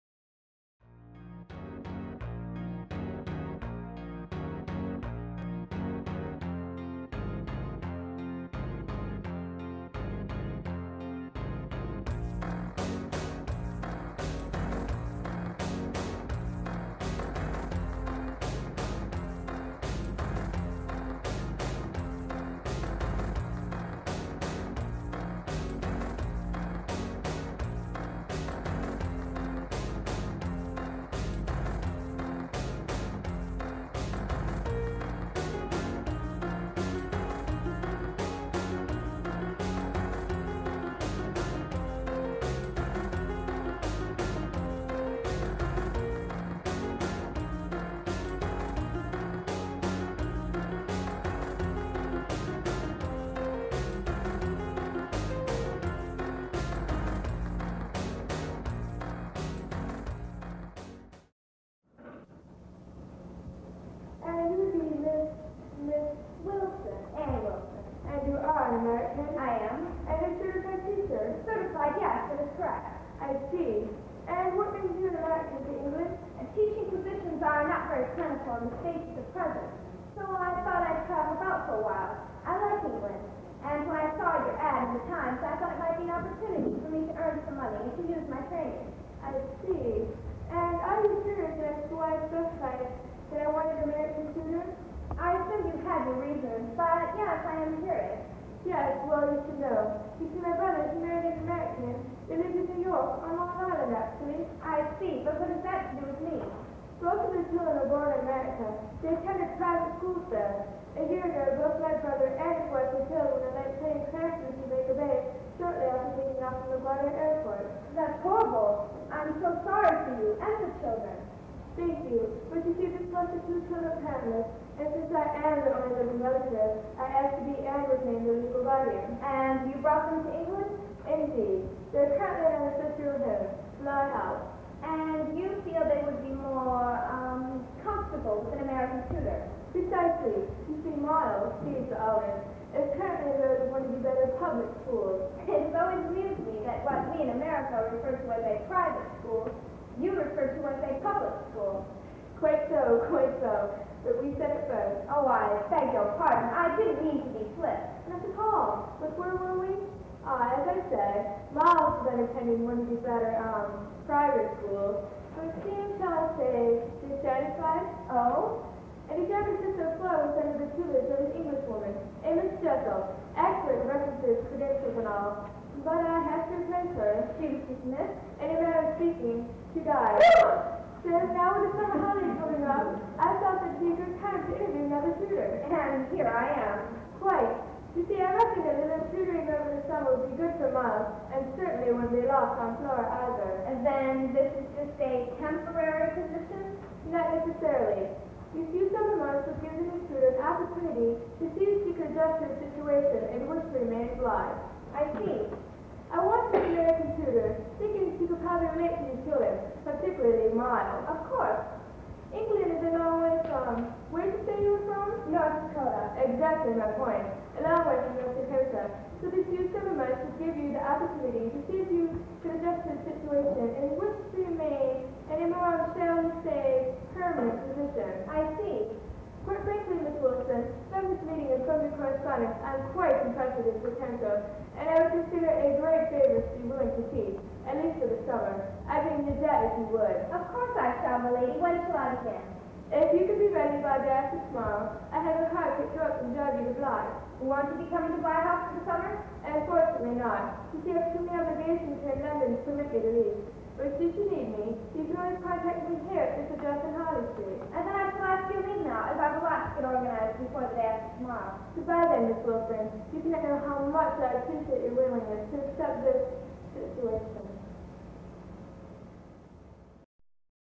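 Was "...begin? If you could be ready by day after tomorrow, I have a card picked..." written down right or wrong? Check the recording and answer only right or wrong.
right.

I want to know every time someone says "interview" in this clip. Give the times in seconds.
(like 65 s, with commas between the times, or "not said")
184 s.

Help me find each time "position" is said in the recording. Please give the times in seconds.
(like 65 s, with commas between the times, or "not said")
76 s, 196 s, 227 s.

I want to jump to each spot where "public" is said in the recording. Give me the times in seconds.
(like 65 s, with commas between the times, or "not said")
144 s, 151 s.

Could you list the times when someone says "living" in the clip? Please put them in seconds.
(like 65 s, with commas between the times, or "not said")
126 s.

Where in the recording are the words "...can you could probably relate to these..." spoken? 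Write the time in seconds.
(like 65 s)
207 s.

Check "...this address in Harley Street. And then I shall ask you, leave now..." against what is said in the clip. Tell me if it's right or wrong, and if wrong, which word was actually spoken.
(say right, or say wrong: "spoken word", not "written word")
right.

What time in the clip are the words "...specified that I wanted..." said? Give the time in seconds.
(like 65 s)
92 s.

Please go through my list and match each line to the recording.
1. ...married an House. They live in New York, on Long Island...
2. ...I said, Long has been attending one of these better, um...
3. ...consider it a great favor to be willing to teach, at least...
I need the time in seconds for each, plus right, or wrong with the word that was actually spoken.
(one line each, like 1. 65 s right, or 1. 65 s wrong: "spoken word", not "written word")
1. 101 s wrong: "American", not "House"
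2. 160 s wrong: "Miles", not "Long"
3. 235 s right.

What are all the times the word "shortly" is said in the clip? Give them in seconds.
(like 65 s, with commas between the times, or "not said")
115 s.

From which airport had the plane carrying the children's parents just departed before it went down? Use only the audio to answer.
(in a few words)
LaGuardia Airport.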